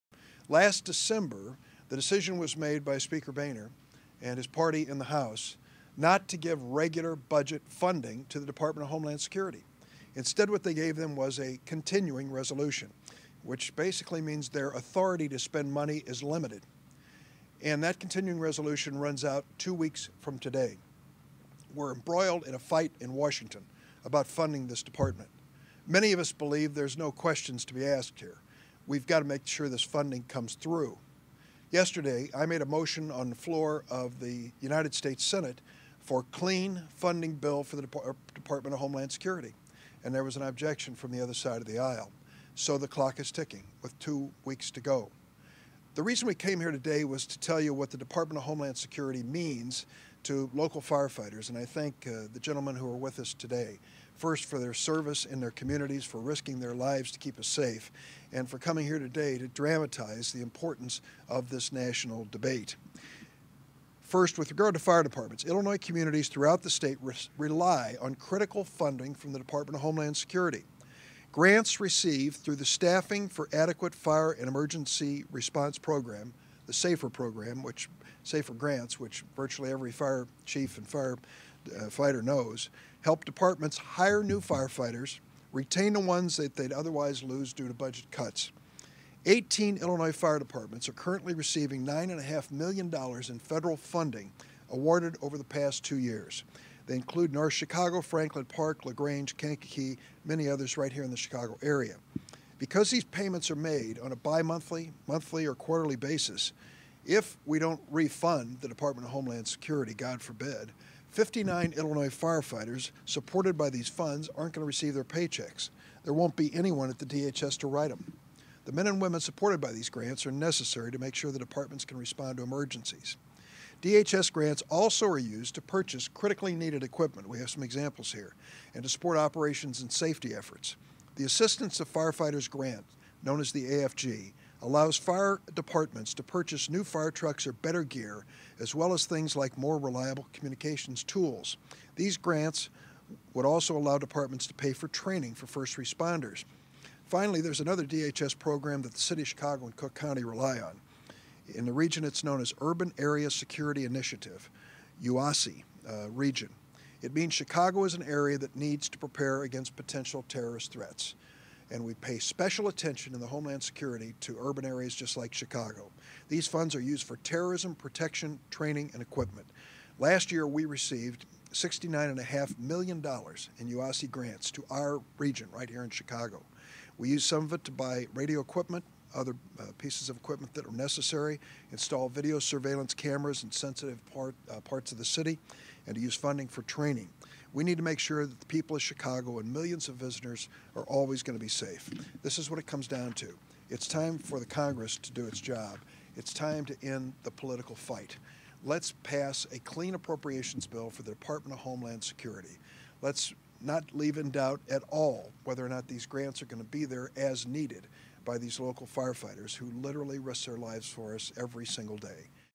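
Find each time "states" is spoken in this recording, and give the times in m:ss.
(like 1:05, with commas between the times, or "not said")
0:34, 1:06.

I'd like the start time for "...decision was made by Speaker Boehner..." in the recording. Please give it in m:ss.
0:01.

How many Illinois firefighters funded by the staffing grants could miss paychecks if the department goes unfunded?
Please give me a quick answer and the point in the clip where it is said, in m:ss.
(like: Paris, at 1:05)
59, at 1:51.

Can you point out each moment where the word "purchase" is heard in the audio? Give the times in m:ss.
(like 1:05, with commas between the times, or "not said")
2:05, 2:16.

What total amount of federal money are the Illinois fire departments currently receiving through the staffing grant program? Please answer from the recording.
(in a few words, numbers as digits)
$9.5 million.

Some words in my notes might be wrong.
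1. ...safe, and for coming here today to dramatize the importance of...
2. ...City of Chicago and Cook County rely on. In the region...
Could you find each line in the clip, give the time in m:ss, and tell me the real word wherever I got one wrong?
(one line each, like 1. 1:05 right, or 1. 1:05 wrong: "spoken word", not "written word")
1. 0:57 right
2. 2:28 right.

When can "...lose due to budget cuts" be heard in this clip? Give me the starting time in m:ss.
1:27.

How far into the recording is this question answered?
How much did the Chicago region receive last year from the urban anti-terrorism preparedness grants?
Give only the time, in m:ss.
2:51.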